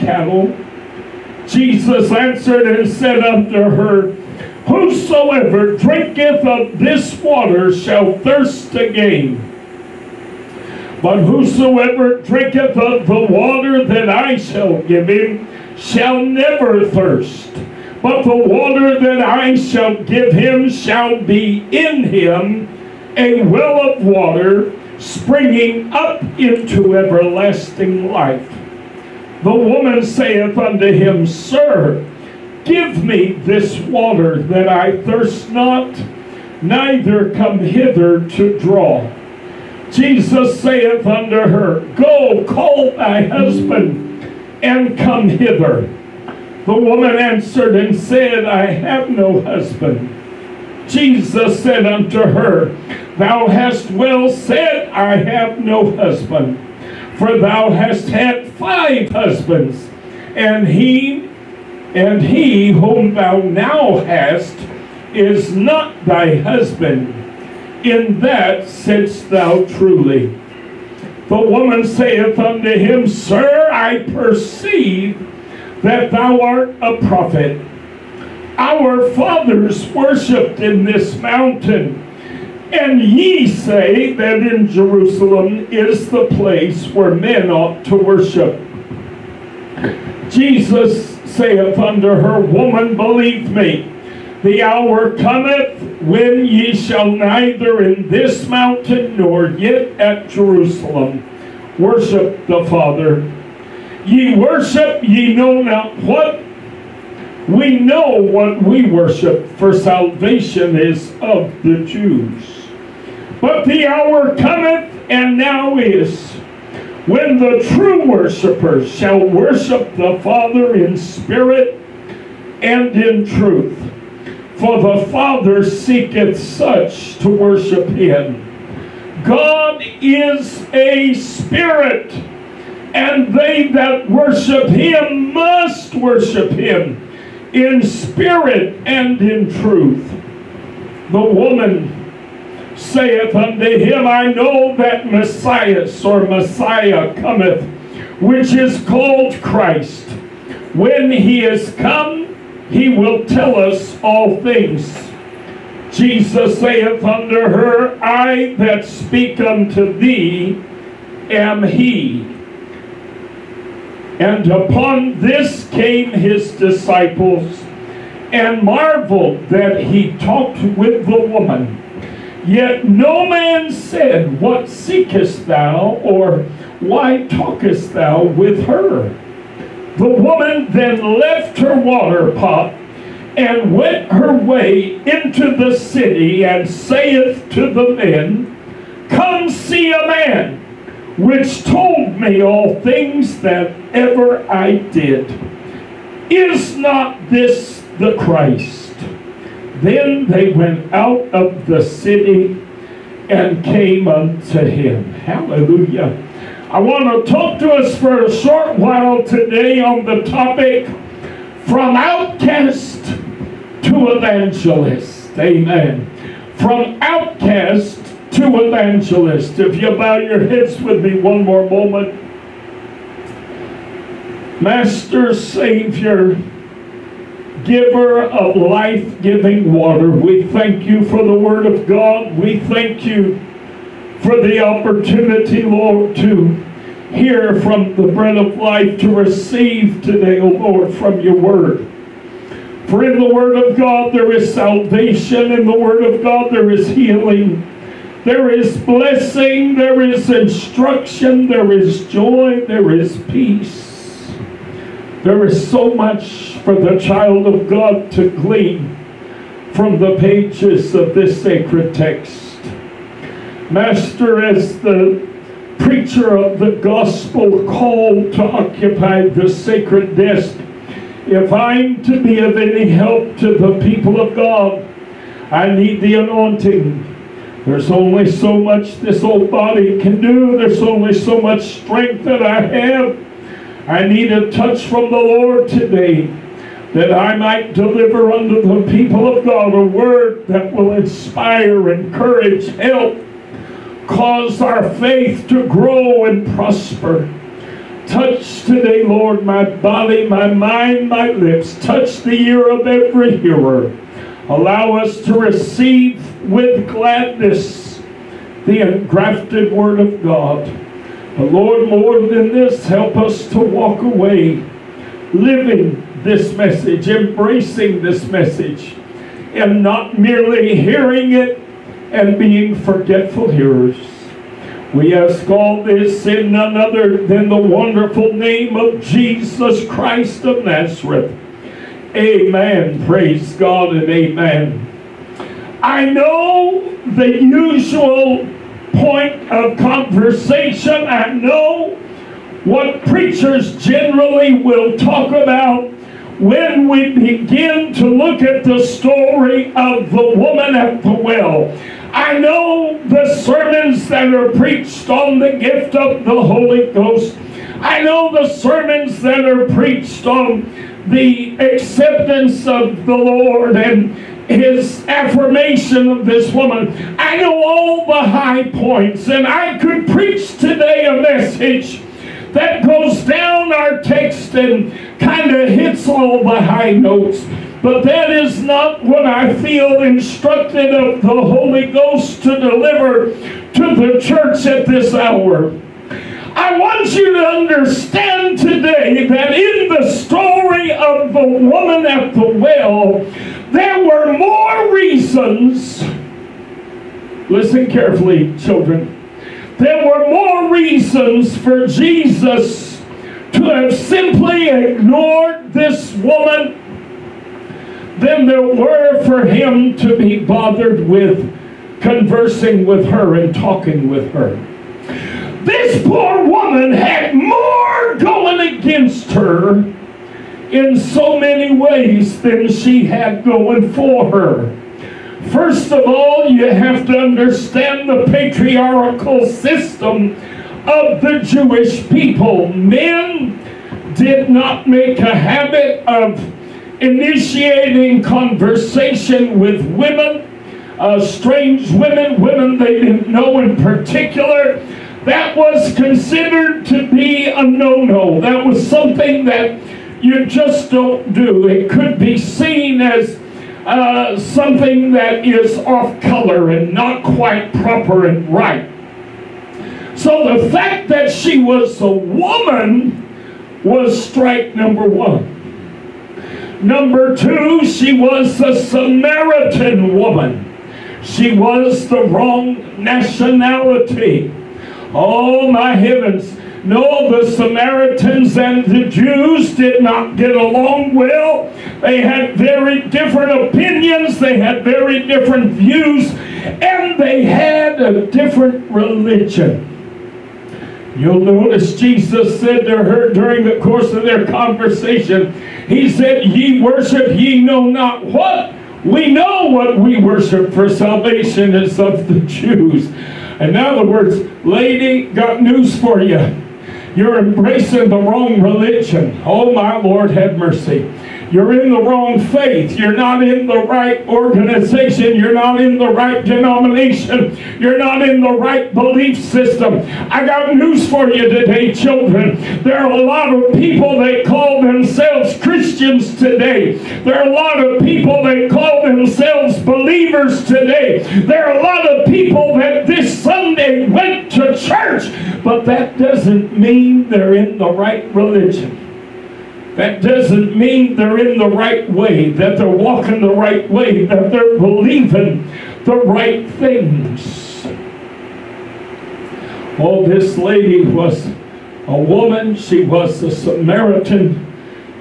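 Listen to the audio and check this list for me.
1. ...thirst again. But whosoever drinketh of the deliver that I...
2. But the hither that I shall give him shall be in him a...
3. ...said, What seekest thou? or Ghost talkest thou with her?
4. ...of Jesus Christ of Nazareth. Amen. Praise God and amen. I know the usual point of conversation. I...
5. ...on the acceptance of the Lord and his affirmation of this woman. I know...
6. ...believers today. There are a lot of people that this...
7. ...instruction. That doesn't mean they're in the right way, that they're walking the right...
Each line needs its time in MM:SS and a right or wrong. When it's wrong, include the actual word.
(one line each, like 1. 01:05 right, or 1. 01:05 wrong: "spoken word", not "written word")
1. 00:08 wrong: "water", not "deliver"
2. 00:18 wrong: "water", not "hither"
3. 02:53 wrong: "Why", not "Ghost"
4. 05:28 right
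5. 06:00 right
6. 08:49 right
7. 08:58 wrong: "religion", not "instruction".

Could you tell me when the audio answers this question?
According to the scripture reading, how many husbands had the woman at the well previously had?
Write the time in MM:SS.
00:58.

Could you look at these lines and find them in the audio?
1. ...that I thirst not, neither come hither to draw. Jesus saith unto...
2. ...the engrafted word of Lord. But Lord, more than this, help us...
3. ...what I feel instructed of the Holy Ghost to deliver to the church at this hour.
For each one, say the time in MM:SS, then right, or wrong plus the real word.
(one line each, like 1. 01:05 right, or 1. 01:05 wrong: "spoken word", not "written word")
1. 00:34 right
2. 05:08 wrong: "God", not "Lord"
3. 06:19 right.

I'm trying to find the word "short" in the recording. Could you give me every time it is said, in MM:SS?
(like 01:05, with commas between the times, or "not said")
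03:28.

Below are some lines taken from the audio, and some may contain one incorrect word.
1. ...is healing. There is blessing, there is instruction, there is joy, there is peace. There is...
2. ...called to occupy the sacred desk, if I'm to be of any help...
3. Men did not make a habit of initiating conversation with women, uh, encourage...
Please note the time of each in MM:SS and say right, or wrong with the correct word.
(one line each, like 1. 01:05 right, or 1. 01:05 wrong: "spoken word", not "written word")
1. 04:06 right
2. 04:27 right
3. 07:12 wrong: "strange", not "encourage".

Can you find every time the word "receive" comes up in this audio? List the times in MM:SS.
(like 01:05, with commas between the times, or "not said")
03:59, 05:05.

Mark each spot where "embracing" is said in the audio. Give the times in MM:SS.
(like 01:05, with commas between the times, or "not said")
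05:17, 08:27.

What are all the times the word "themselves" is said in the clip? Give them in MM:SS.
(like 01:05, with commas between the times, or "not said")
08:44, 08:49.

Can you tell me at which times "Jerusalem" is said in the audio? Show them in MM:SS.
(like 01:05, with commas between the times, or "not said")
01:24, 01:40.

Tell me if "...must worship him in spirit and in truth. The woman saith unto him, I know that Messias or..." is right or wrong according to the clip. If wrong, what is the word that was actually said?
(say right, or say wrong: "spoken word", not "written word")
right.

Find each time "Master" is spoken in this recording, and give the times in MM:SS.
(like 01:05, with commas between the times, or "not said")
03:44, 04:23.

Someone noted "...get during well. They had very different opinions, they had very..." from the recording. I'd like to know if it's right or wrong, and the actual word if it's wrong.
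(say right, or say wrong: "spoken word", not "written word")
wrong: "along", not "during".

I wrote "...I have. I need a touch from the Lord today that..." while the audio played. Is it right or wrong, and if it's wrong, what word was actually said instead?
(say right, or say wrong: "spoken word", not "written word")
right.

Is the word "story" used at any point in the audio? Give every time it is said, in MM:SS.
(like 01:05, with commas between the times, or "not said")
05:48, 06:30.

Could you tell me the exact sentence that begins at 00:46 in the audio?
The woman answered and said, I have no husband.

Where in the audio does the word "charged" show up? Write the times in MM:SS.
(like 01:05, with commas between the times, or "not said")
not said.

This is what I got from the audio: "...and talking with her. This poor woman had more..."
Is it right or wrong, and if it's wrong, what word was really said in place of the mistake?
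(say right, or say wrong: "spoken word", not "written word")
right.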